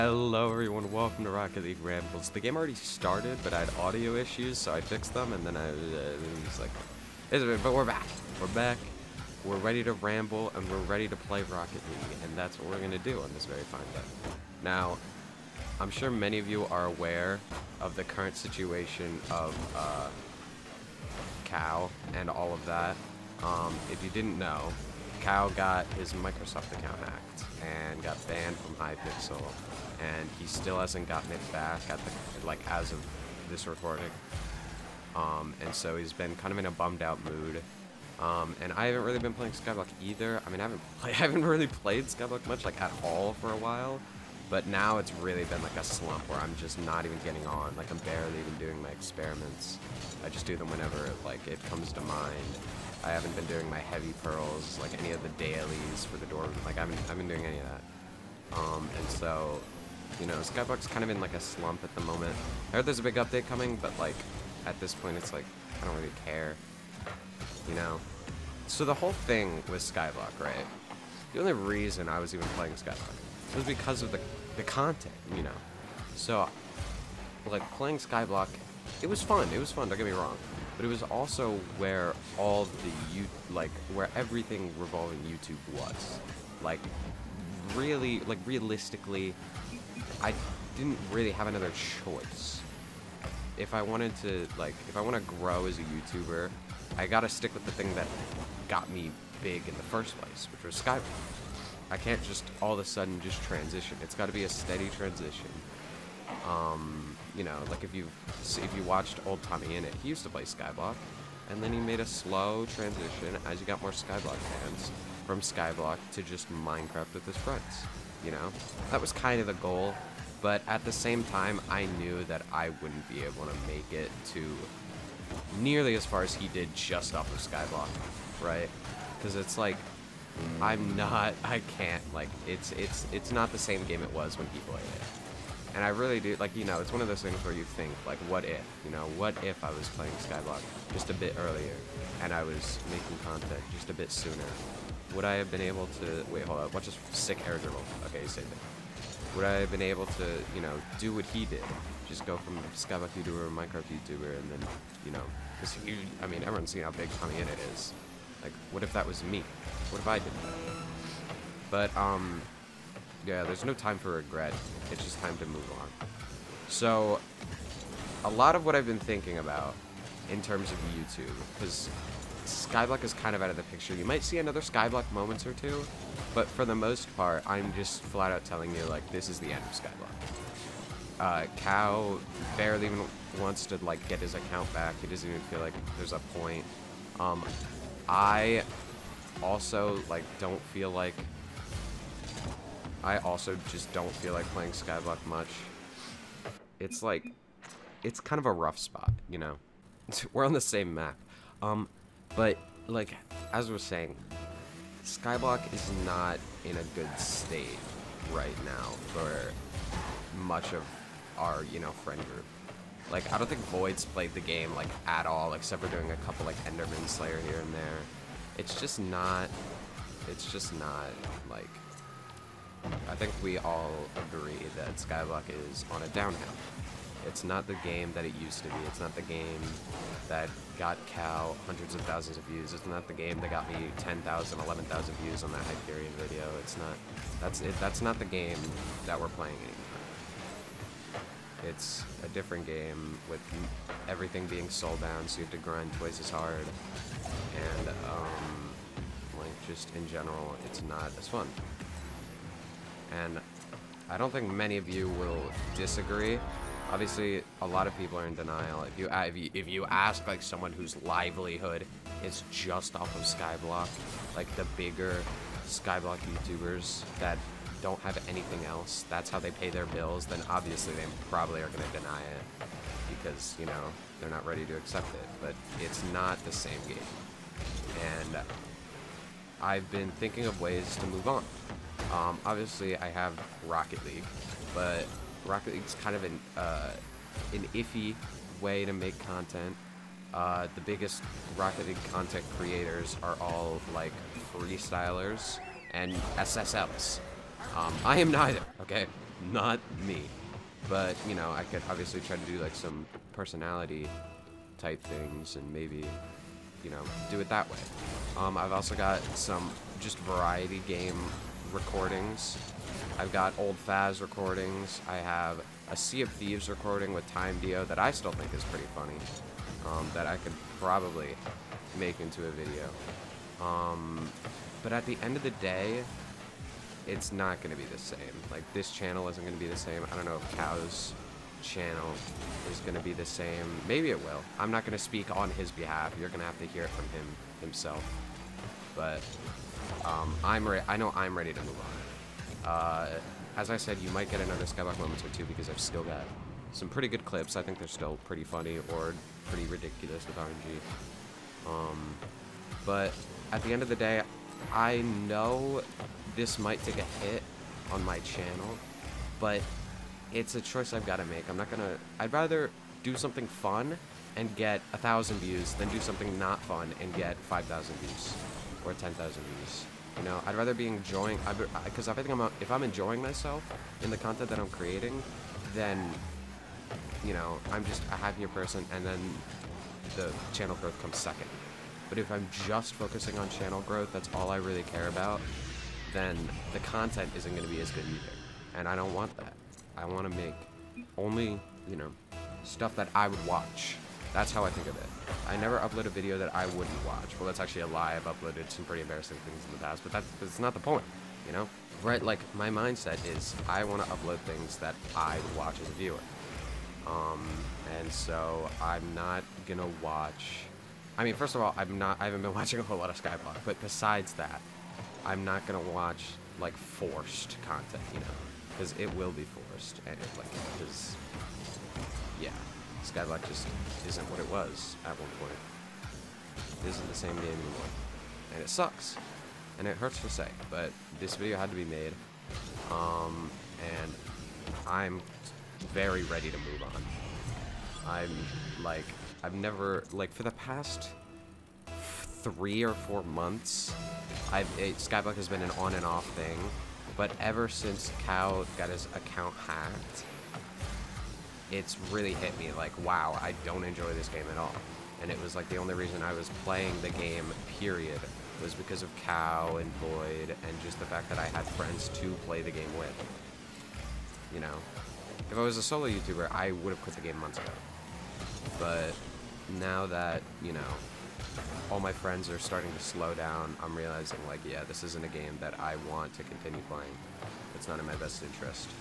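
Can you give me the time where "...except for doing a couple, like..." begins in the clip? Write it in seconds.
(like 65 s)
215 s.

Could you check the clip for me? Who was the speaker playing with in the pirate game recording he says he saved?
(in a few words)
TimeDeo.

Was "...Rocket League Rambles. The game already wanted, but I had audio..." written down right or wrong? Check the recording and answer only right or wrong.
wrong.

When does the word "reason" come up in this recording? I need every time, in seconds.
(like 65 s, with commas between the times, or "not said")
71 s, 455 s.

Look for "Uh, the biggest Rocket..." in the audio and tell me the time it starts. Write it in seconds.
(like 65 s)
290 s.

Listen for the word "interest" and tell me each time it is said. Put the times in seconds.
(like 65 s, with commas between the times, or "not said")
478 s.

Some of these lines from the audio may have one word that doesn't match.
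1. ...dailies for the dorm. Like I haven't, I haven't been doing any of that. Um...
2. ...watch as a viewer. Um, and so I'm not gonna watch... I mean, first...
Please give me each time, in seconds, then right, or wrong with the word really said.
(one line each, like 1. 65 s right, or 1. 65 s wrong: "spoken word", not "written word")
1. 55 s right
2. 405 s right.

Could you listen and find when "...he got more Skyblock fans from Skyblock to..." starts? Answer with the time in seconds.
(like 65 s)
113 s.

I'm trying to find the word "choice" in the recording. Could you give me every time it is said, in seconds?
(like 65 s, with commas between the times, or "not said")
92 s, 360 s.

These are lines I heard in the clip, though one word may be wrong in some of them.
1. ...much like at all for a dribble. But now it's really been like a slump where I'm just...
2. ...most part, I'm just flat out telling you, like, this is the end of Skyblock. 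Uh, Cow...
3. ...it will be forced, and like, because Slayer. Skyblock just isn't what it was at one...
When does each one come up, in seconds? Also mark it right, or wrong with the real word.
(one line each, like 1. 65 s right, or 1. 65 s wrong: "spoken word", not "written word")
1. 42 s wrong: "while", not "dribble"
2. 176 s right
3. 418 s wrong: "Yeah", not "Slayer".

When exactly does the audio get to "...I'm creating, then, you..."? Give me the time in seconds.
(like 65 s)
374 s.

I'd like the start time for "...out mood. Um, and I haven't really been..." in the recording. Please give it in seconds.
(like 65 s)
37 s.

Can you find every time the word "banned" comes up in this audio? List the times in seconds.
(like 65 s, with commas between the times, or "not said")
28 s.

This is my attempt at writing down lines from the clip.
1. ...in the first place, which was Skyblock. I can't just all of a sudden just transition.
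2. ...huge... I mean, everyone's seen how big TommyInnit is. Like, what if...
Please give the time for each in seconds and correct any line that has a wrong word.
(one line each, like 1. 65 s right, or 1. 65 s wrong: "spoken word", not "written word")
1. 99 s right
2. 155 s right.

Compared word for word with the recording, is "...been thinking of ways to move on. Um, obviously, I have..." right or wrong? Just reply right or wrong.
right.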